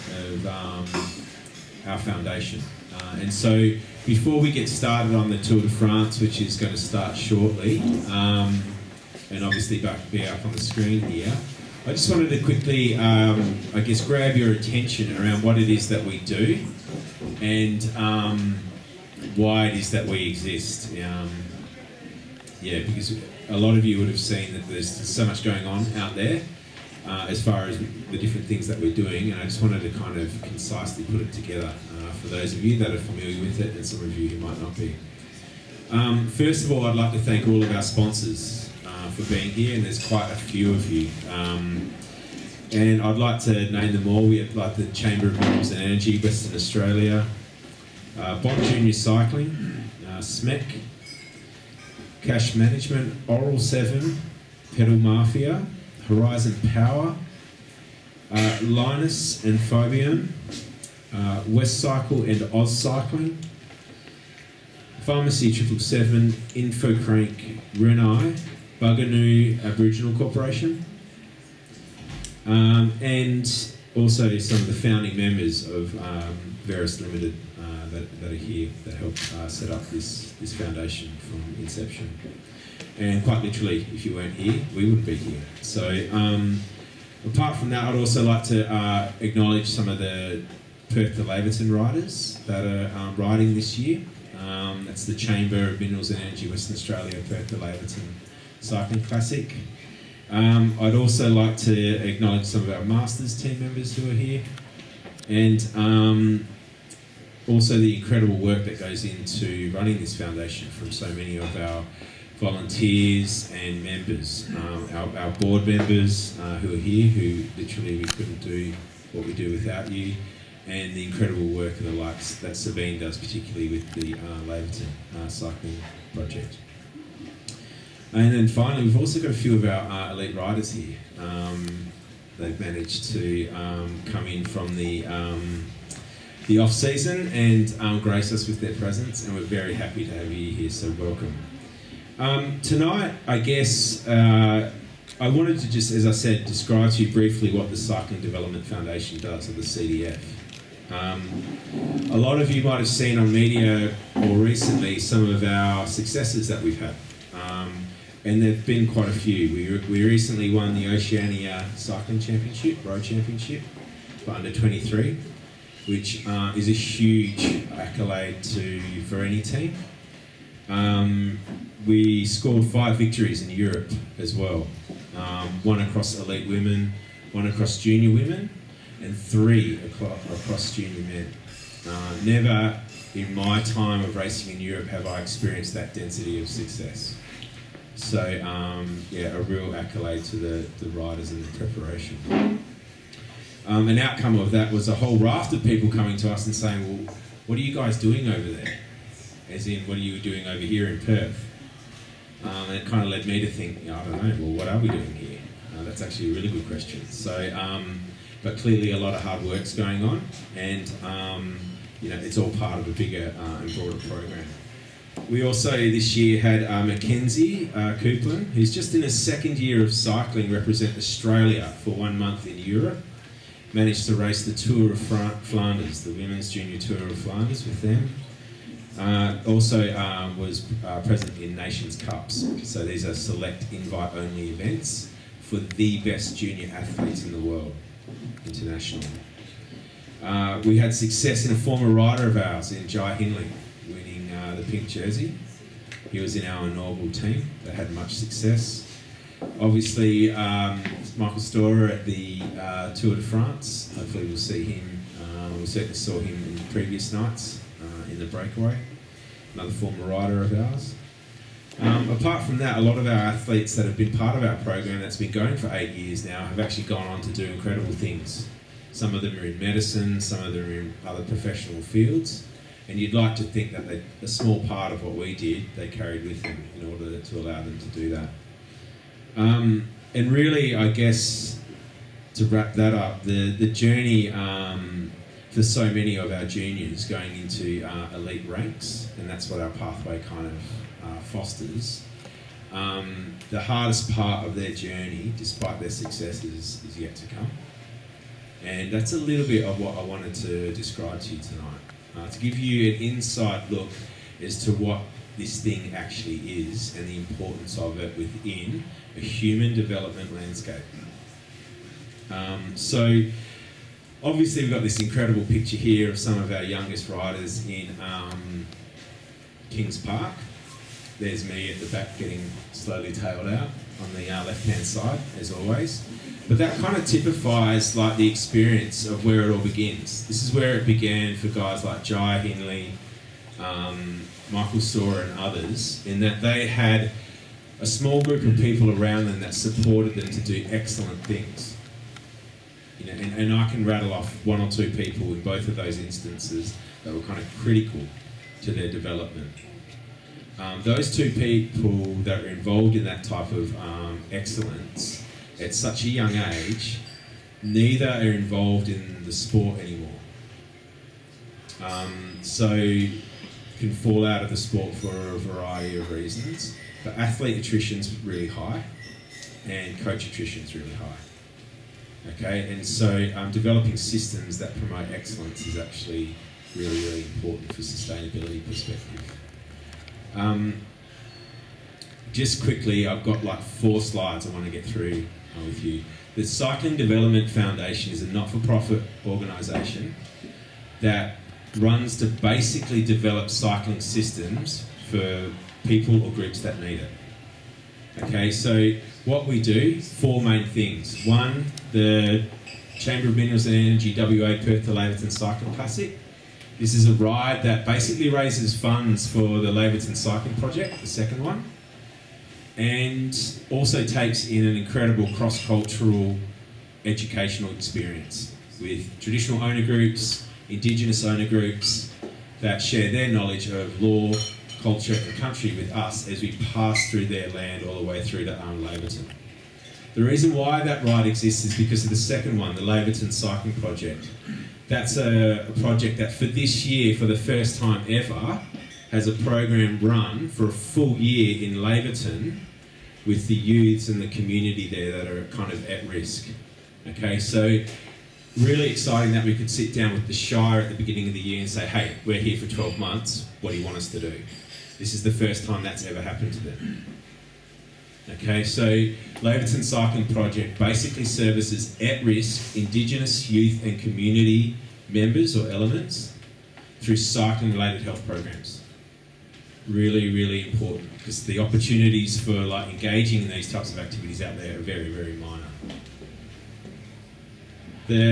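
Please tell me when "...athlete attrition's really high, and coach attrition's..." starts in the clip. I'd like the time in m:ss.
6:07.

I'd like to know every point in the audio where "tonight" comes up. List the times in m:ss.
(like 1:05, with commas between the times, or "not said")
2:22, 5:01.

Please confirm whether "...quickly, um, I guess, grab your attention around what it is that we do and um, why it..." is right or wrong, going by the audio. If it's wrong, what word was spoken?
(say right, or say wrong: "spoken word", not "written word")
right.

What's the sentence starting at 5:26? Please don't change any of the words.
But that kind of typifies like the experience of where it all begins.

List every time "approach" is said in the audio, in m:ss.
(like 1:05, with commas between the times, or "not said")
not said.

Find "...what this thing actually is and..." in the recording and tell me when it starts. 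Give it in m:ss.
5:04.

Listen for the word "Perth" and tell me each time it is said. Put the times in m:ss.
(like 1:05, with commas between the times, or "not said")
1:30, 1:37, 3:21, 6:44.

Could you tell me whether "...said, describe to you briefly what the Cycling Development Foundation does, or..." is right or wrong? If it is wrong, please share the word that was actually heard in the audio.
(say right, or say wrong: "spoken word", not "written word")
right.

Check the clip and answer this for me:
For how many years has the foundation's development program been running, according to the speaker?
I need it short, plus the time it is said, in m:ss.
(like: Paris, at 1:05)
8, at 4:25.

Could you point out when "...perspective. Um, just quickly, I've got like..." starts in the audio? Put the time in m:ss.
6:18.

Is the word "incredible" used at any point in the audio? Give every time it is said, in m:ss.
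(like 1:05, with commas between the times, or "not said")
1:47, 2:01, 4:27, 5:14, 6:54.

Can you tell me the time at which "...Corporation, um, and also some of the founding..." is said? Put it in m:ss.
1:10.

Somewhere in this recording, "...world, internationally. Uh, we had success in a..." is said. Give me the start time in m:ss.
3:57.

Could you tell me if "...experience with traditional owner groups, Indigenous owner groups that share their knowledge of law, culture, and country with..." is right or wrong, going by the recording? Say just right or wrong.
right.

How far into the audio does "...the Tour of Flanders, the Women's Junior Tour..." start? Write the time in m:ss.
3:44.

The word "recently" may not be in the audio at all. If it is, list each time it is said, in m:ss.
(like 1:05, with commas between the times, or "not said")
2:34, 2:40.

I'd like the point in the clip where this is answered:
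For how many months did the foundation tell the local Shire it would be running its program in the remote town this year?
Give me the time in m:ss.
7:32.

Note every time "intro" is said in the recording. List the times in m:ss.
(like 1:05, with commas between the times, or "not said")
not said.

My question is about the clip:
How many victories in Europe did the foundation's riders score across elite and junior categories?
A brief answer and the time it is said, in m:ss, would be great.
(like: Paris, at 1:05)
5, at 2:52.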